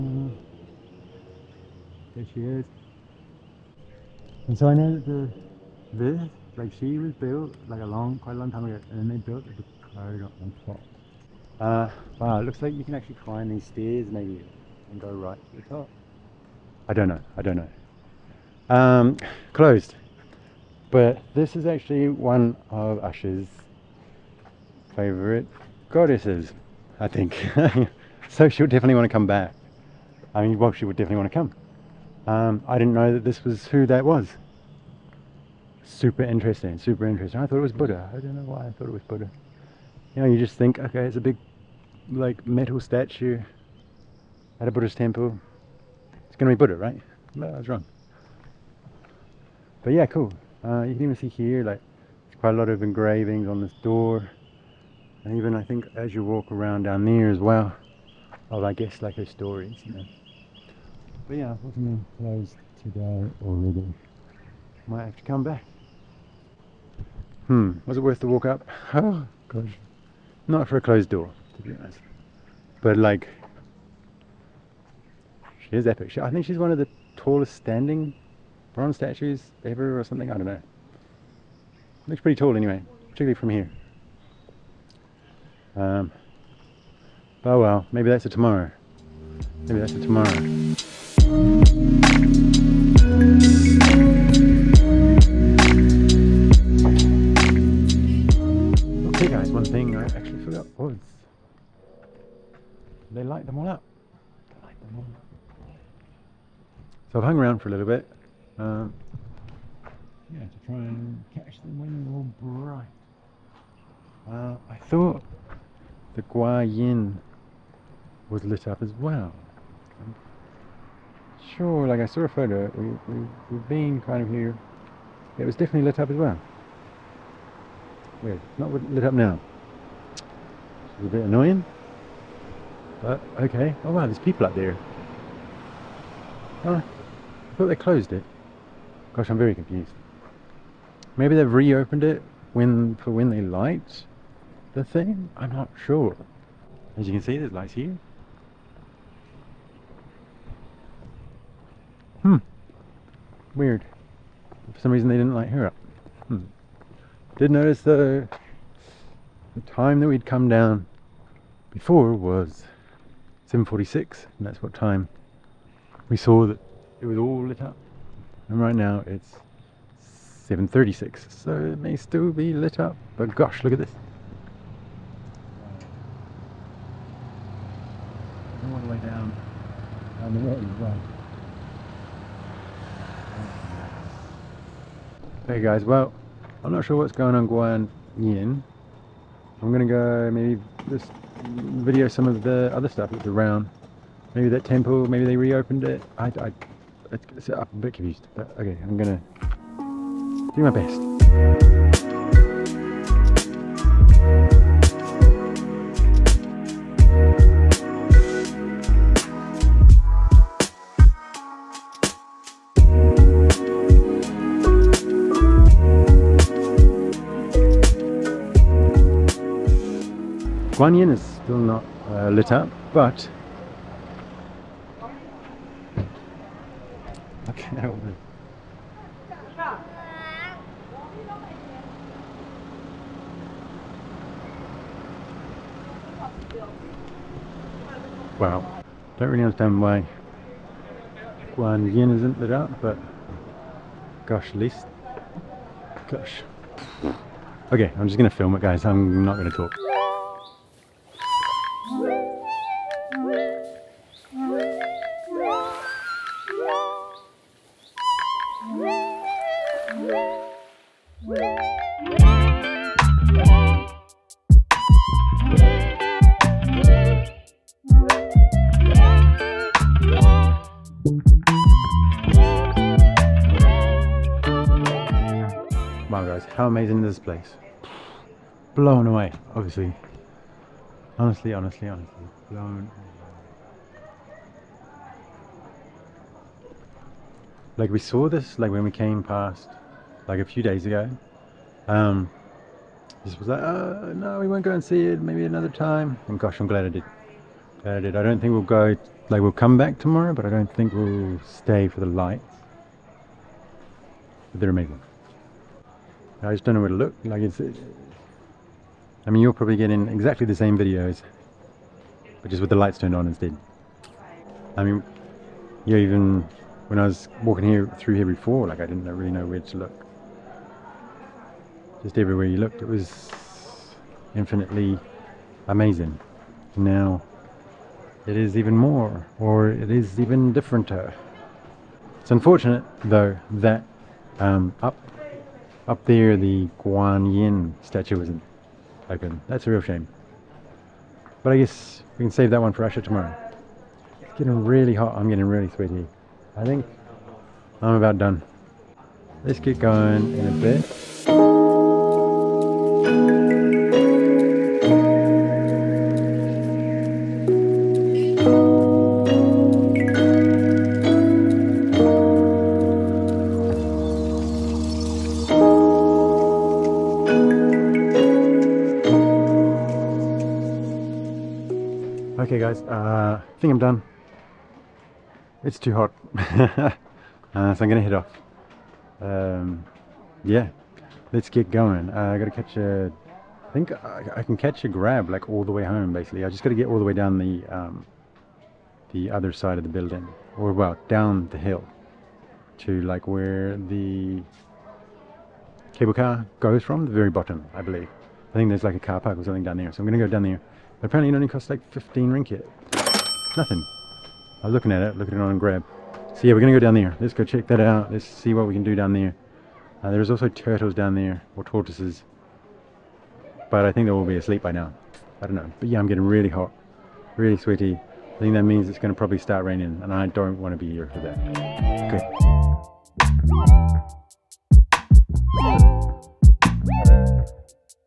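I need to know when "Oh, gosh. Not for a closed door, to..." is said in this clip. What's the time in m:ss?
1:08.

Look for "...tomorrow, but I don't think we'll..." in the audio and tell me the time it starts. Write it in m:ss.
4:59.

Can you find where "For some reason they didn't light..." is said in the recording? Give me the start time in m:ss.
2:34.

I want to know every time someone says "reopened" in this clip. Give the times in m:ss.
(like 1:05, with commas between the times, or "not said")
2:21, 3:15.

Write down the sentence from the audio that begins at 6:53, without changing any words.
But I think they will be asleep by now.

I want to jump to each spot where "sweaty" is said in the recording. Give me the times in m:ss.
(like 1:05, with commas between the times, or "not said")
5:45, 6:57.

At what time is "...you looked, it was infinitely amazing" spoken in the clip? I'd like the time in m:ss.
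5:22.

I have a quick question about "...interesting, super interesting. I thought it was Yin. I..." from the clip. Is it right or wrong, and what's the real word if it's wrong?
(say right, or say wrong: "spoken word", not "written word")
wrong: "Buddha", not "Yin".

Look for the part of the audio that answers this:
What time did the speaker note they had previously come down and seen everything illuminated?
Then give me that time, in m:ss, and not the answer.
2:43.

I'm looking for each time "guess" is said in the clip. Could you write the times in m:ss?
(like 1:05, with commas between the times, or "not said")
0:58, 5:41.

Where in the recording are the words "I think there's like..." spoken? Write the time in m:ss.
6:38.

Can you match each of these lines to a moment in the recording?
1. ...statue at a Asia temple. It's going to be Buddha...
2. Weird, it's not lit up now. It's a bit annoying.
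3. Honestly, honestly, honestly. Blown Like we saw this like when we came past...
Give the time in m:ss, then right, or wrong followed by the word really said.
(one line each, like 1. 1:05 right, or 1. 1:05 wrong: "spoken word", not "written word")
1. 0:42 wrong: "Buddhist", not "Asia"
2. 2:08 right
3. 4:41 right.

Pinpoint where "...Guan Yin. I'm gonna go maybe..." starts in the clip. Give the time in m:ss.
3:07.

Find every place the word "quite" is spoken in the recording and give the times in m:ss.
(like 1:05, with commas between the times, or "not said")
0:08, 0:52.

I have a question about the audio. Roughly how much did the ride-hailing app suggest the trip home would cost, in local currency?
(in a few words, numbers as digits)
15 ringgit.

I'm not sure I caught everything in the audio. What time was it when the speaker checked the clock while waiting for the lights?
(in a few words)
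7:36.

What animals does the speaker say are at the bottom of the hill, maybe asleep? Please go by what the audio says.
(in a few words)
Turtles.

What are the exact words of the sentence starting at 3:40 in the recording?
Guan Yin is still not uh, lit up, but look at that woman.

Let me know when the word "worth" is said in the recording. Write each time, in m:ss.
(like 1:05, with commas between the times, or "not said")
1:07.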